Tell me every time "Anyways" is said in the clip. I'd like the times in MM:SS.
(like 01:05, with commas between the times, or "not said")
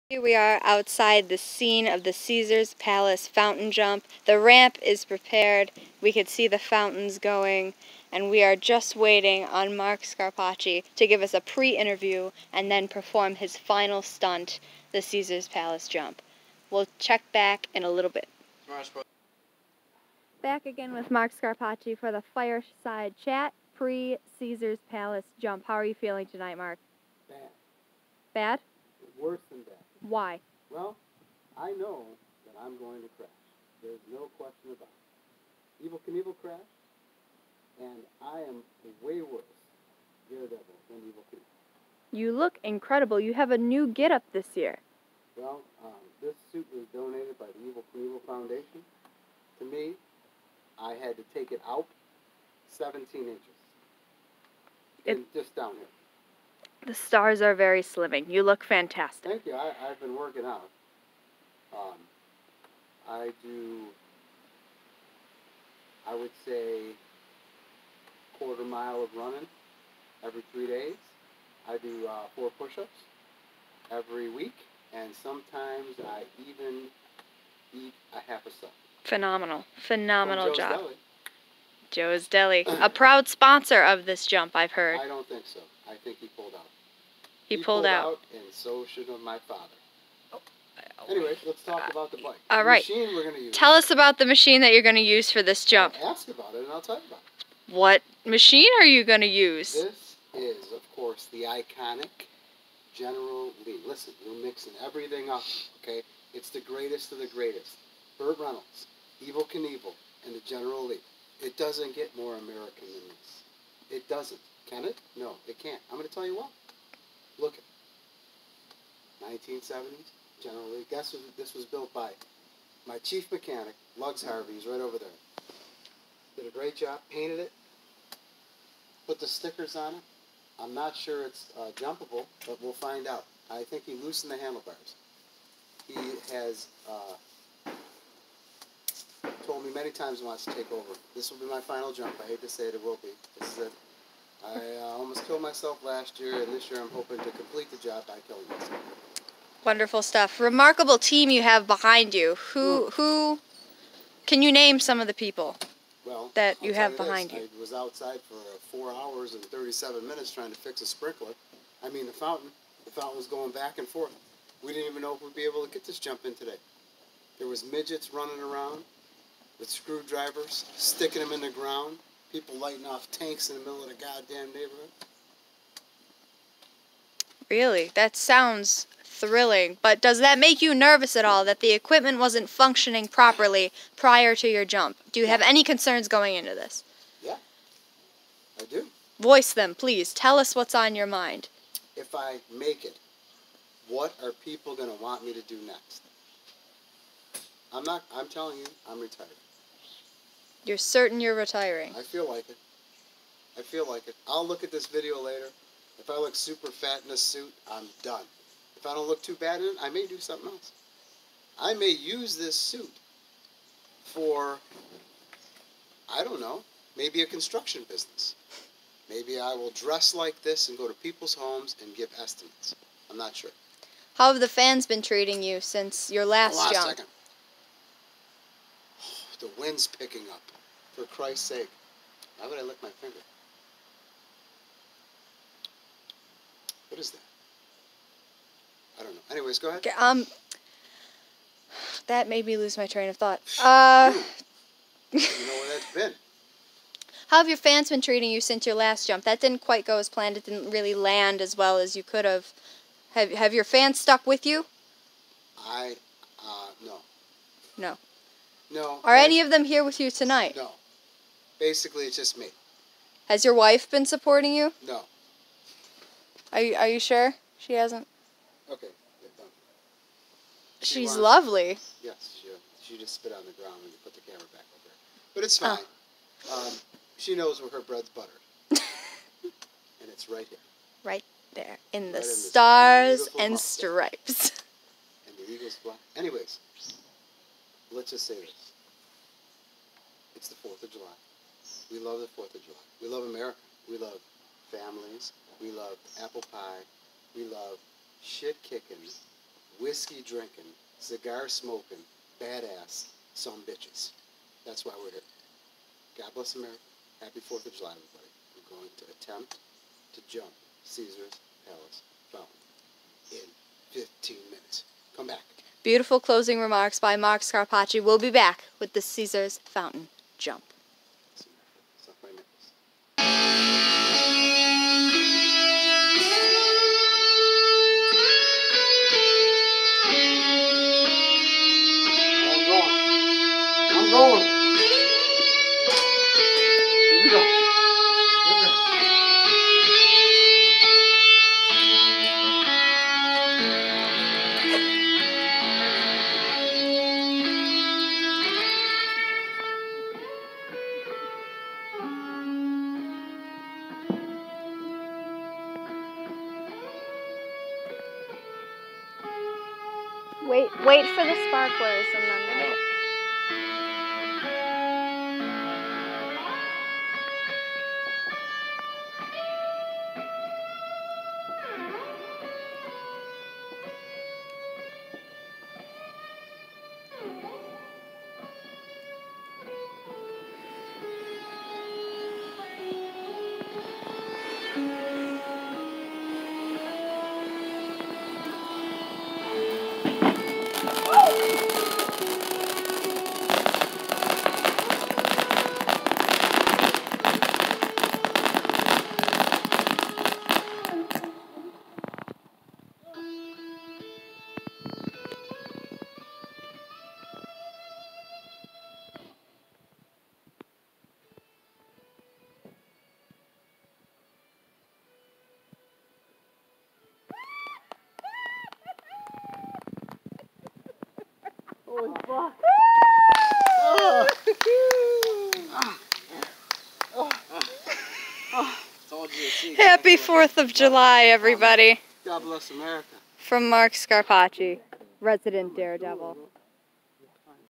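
01:31, 03:59, 04:46.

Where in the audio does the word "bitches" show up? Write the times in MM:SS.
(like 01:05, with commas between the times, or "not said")
05:03.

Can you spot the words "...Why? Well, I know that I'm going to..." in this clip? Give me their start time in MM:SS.
00:30.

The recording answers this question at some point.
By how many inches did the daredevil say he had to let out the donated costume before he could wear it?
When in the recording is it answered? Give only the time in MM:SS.
00:52.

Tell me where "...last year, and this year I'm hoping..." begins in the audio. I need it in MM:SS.
02:25.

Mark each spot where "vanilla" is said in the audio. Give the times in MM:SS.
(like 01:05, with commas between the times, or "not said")
not said.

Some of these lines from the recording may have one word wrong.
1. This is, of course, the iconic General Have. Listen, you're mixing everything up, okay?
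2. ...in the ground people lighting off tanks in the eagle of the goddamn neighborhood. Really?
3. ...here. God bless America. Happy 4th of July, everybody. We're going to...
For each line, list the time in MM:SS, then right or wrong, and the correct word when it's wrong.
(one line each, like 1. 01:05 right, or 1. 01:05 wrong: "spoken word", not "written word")
1. 01:39 wrong: "Lee", not "Have"
2. 02:51 wrong: "middle", not "eagle"
3. 05:05 right.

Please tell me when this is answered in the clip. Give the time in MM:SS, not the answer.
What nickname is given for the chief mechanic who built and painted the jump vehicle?
02:03.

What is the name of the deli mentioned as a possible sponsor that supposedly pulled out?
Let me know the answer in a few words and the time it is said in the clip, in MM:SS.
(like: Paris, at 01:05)
Joe's Deli, at 01:21.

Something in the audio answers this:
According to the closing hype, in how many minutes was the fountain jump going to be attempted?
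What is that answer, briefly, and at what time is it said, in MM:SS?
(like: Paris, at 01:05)
15 minutes, at 05:13.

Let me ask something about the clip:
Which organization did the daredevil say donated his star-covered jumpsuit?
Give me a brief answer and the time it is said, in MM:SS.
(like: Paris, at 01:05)
Evel Knievel Foundation, at 00:47.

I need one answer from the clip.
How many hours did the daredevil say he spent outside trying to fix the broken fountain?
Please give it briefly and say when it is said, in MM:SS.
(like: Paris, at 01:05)
4 hours, at 02:38.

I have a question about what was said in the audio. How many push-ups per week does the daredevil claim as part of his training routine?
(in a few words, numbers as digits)
4.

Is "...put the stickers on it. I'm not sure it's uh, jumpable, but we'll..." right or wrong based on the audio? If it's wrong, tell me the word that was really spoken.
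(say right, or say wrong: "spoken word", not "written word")
right.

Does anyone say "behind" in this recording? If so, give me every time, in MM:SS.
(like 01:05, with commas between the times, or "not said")
02:31, 02:36.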